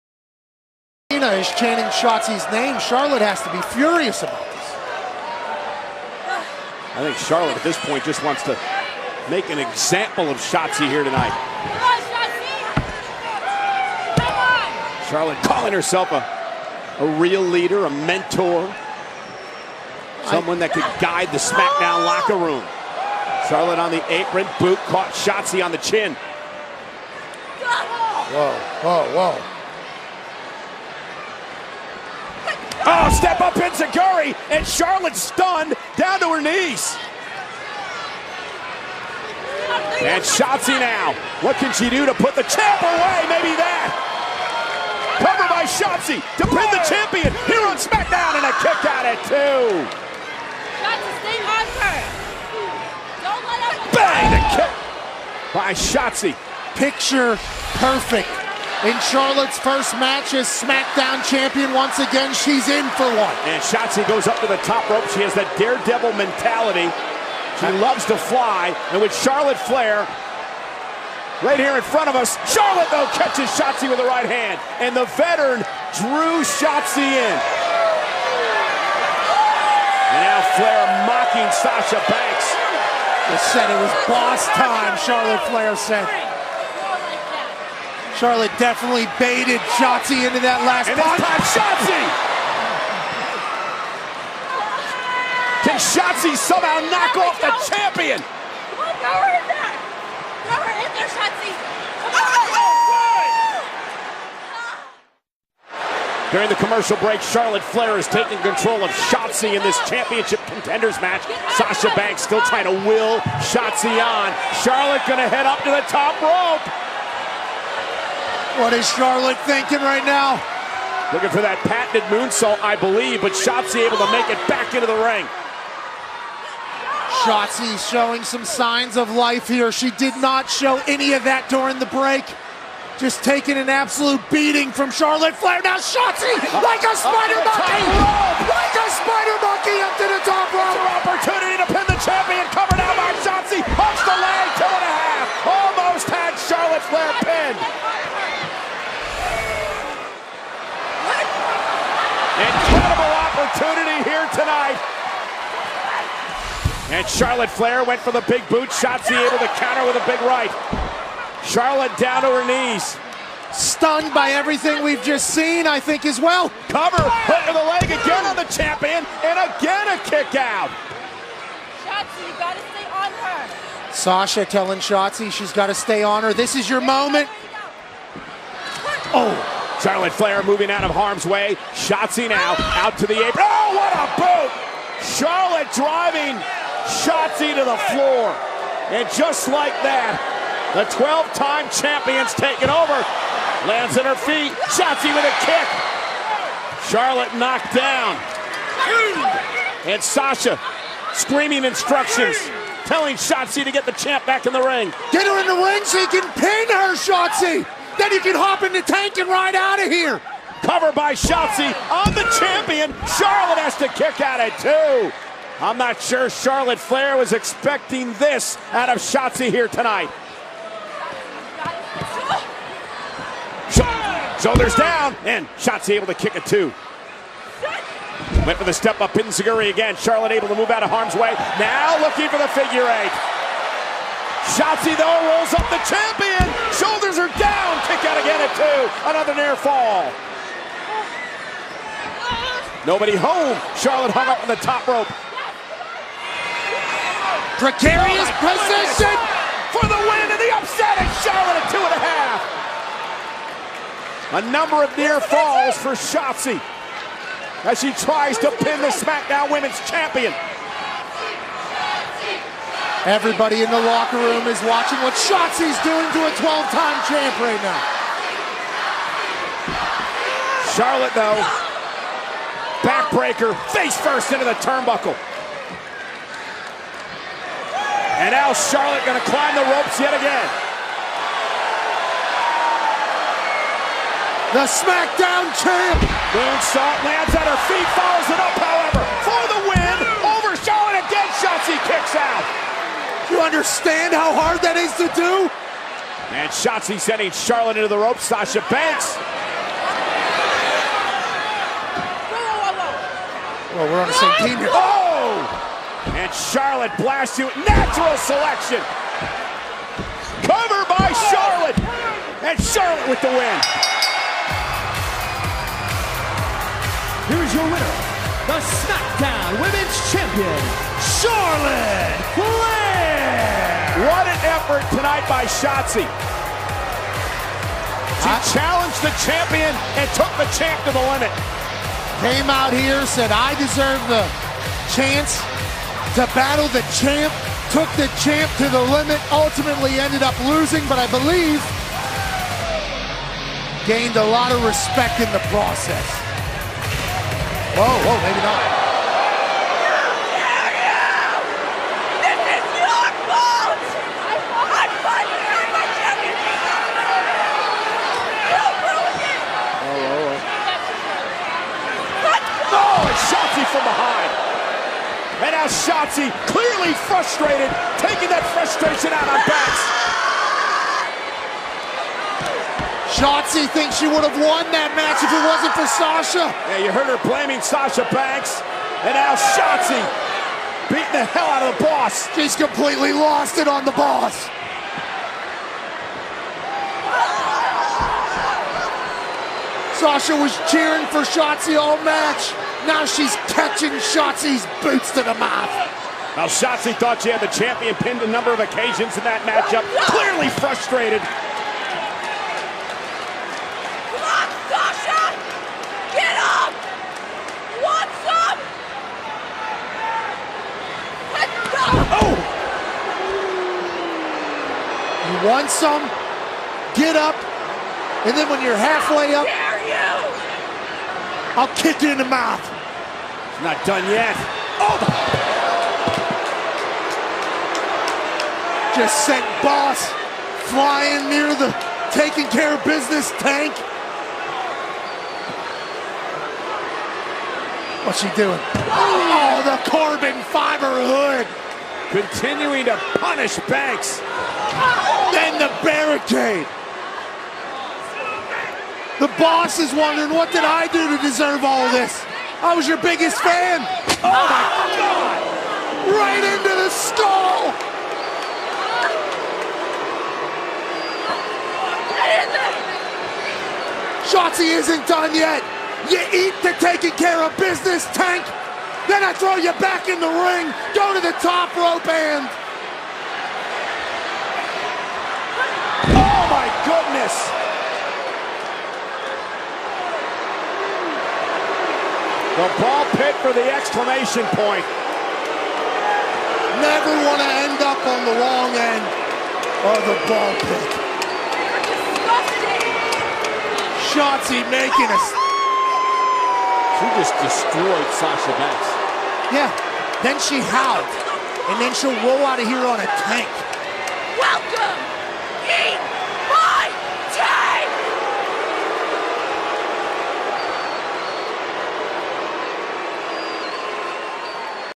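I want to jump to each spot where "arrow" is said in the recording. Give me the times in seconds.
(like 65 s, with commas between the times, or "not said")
not said.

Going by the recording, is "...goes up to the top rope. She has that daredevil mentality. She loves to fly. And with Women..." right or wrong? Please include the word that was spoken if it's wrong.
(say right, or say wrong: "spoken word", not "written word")
wrong: "Charlotte", not "Women".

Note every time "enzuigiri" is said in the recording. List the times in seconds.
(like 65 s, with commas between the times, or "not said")
33 s, 229 s.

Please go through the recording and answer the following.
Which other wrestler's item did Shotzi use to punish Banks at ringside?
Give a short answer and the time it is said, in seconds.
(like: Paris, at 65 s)
Corbin fiber hood, at 439 s.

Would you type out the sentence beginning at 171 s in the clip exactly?
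Shotzi, you gotta stay on her.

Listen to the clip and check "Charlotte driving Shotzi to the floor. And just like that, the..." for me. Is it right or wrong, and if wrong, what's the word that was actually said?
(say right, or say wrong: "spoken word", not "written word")
right.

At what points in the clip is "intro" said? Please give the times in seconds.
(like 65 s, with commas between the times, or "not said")
not said.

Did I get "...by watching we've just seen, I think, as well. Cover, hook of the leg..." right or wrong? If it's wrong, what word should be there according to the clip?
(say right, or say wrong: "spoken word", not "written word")
wrong: "everything", not "watching".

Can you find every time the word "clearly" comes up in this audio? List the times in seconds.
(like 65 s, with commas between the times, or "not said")
366 s, 400 s.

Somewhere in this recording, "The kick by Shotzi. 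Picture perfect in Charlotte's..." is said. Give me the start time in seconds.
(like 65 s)
54 s.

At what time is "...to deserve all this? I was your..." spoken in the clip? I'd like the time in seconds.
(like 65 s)
451 s.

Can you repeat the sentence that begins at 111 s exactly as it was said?
Sasha Banks still trying to will Shotzi on.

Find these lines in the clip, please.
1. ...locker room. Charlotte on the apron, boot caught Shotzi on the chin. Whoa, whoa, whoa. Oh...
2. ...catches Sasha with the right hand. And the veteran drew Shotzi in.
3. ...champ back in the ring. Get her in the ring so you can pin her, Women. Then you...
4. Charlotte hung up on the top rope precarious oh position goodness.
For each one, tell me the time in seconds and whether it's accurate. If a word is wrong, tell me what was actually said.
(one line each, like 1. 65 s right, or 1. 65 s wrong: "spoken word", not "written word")
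1. 22 s right
2. 73 s wrong: "Shotzi", not "Sasha"
3. 203 s wrong: "Shotzi", not "Women"
4. 243 s right.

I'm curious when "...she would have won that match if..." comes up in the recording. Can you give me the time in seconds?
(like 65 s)
373 s.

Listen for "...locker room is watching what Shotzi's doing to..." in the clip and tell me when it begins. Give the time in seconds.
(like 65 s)
263 s.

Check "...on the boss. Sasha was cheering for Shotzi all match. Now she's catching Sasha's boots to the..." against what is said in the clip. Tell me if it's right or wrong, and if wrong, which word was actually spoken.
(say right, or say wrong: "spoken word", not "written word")
wrong: "Shotzi", not "Sasha".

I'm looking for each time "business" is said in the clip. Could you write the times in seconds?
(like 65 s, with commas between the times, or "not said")
432 s, 467 s.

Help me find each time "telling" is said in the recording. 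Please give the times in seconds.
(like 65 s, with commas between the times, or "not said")
174 s, 202 s.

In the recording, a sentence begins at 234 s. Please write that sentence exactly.
Shotzi, though, rolls up the champion.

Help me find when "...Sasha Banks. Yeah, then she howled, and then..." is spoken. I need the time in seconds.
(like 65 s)
498 s.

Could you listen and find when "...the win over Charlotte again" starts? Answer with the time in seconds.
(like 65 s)
289 s.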